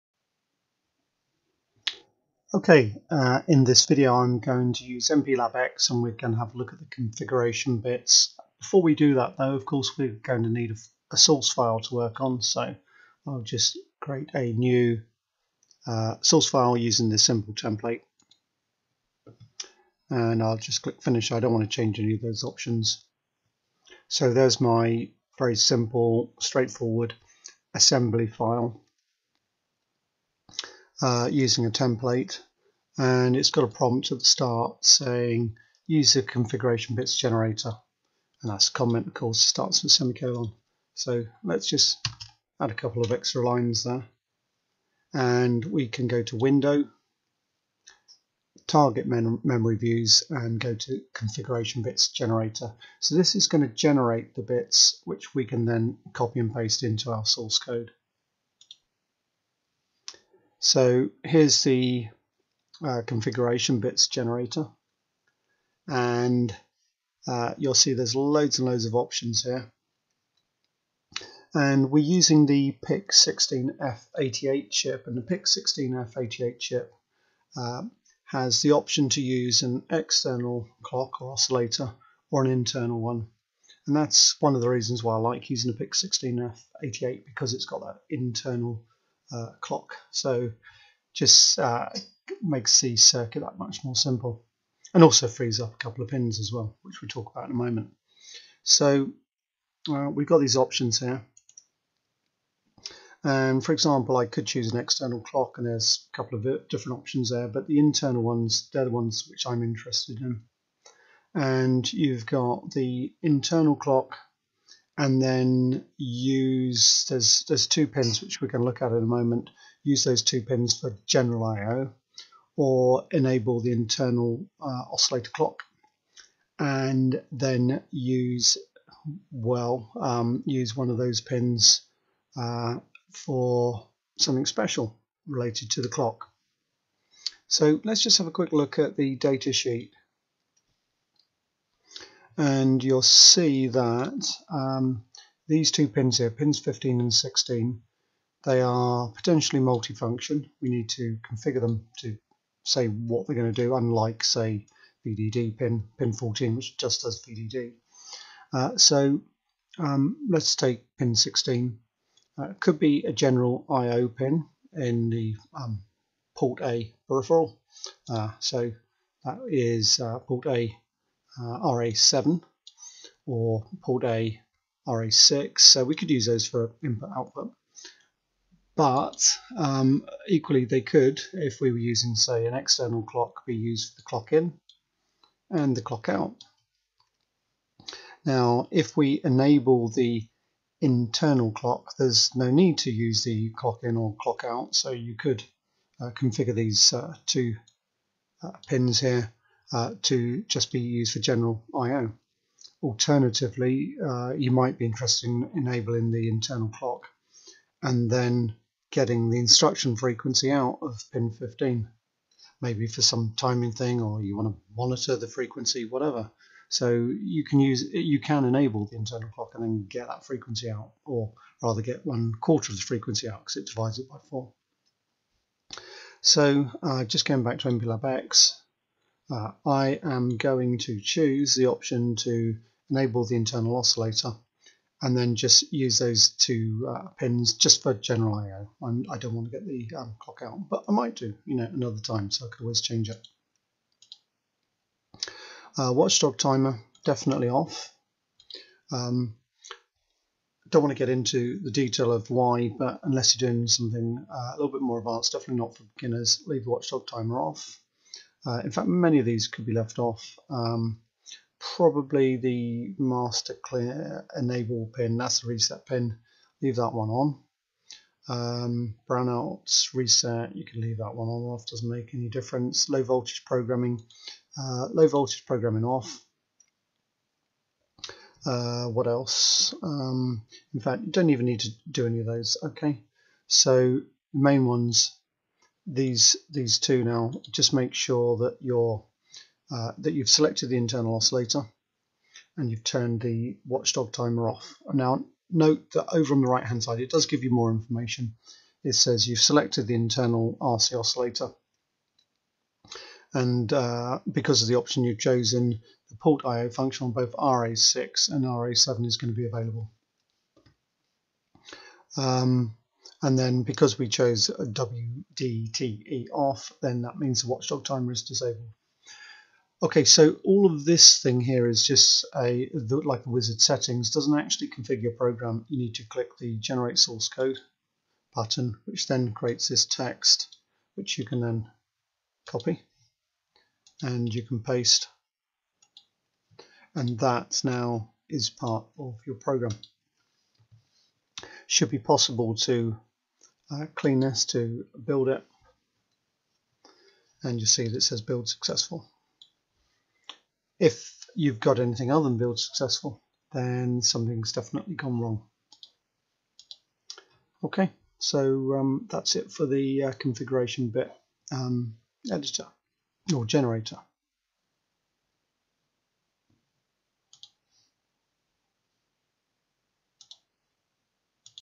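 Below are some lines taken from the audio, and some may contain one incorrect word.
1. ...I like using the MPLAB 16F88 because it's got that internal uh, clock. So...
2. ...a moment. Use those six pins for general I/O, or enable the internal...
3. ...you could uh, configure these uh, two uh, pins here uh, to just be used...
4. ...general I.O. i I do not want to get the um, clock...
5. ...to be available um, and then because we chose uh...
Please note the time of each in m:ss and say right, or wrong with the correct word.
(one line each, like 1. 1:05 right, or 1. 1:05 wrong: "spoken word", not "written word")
1. 1:25 wrong: "PIC", not "MPLAB"
2. 1:58 wrong: "two", not "six"
3. 3:14 right
4. 3:57 right
5. 5:09 right.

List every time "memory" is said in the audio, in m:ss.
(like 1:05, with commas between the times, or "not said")
0:49.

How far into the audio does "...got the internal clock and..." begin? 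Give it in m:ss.
1:52.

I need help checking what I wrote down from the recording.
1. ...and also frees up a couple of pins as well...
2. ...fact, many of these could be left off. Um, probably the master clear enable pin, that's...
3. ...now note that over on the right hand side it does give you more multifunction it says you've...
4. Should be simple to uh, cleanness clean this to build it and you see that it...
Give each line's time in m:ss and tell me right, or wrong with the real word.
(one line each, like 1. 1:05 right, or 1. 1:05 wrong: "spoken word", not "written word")
1. 1:34 right
2. 4:18 right
3. 4:54 wrong: "information", not "multifunction"
4. 5:41 wrong: "possible", not "simple".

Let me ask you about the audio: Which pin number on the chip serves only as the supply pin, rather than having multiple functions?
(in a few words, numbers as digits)
14.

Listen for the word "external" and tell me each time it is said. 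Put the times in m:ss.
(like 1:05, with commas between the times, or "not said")
1:19, 1:44, 3:02.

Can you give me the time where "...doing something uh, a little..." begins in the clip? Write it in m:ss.
4:13.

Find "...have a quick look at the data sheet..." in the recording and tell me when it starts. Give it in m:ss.
2:18.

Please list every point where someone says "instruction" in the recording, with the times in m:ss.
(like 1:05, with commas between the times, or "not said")
3:29.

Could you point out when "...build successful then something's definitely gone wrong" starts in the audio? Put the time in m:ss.
5:52.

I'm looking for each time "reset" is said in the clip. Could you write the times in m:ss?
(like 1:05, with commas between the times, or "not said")
4:25, 4:29.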